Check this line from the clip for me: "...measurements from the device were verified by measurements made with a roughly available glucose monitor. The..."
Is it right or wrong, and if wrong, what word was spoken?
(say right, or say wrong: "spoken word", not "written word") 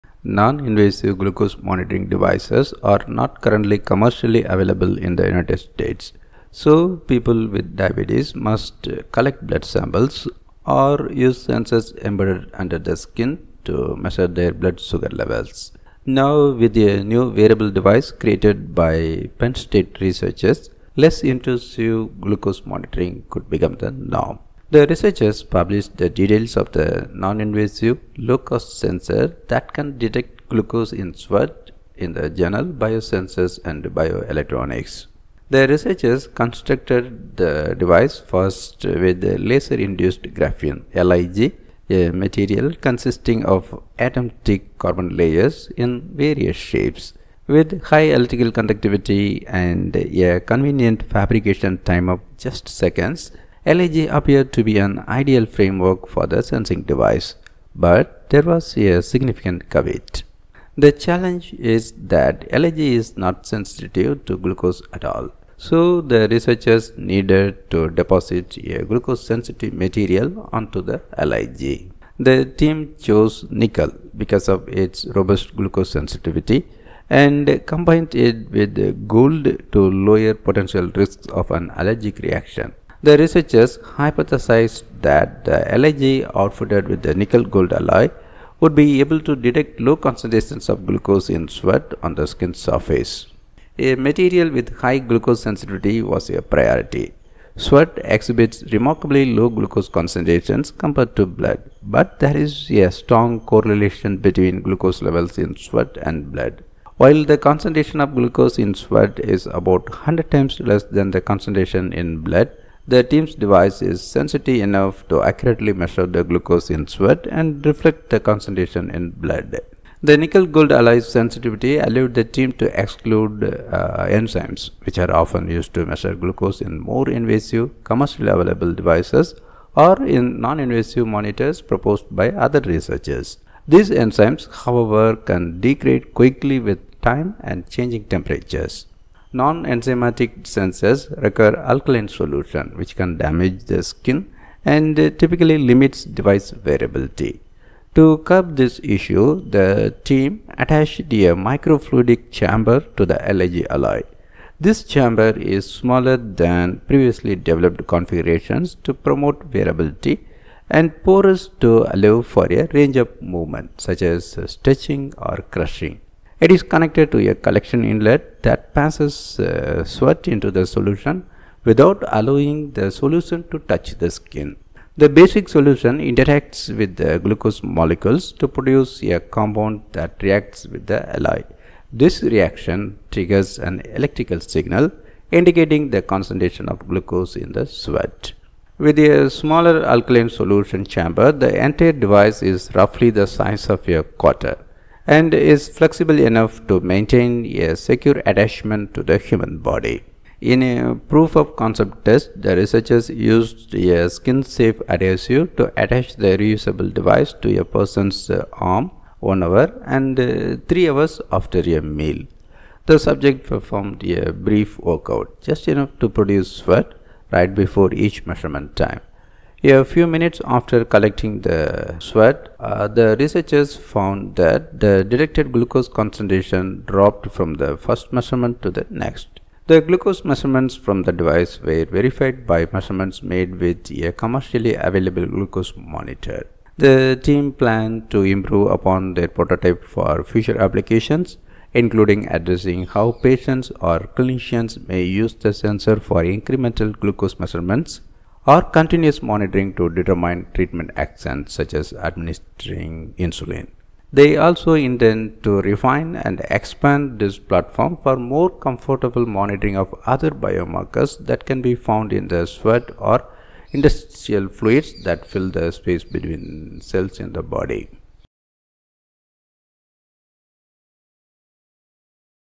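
wrong: "commercially", not "roughly".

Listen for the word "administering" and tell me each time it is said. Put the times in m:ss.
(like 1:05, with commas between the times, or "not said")
4:11.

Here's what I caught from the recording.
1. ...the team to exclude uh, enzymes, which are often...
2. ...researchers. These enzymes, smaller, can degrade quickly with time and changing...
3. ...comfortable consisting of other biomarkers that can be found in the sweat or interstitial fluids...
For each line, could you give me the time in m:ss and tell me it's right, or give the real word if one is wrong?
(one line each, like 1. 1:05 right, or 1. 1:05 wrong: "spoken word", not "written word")
1. 2:02 right
2. 2:12 wrong: "however", not "smaller"
3. 4:18 wrong: "monitoring", not "consisting".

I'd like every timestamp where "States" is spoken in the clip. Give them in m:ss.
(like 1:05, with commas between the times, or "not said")
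0:05, 0:19.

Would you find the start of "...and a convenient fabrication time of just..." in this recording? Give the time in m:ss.
0:49.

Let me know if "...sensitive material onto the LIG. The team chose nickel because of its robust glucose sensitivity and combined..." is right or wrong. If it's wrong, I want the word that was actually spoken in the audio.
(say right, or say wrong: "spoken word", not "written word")
right.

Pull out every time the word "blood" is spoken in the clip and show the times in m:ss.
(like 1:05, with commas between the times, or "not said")
0:09, 0:14, 1:41, 1:46, 1:52, 1:59.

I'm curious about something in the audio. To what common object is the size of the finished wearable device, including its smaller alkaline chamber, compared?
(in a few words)
a quarter.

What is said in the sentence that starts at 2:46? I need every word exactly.
It is connected to a collection inlet that passes uh, sweat into the solution without allowing the solution to touch the skin.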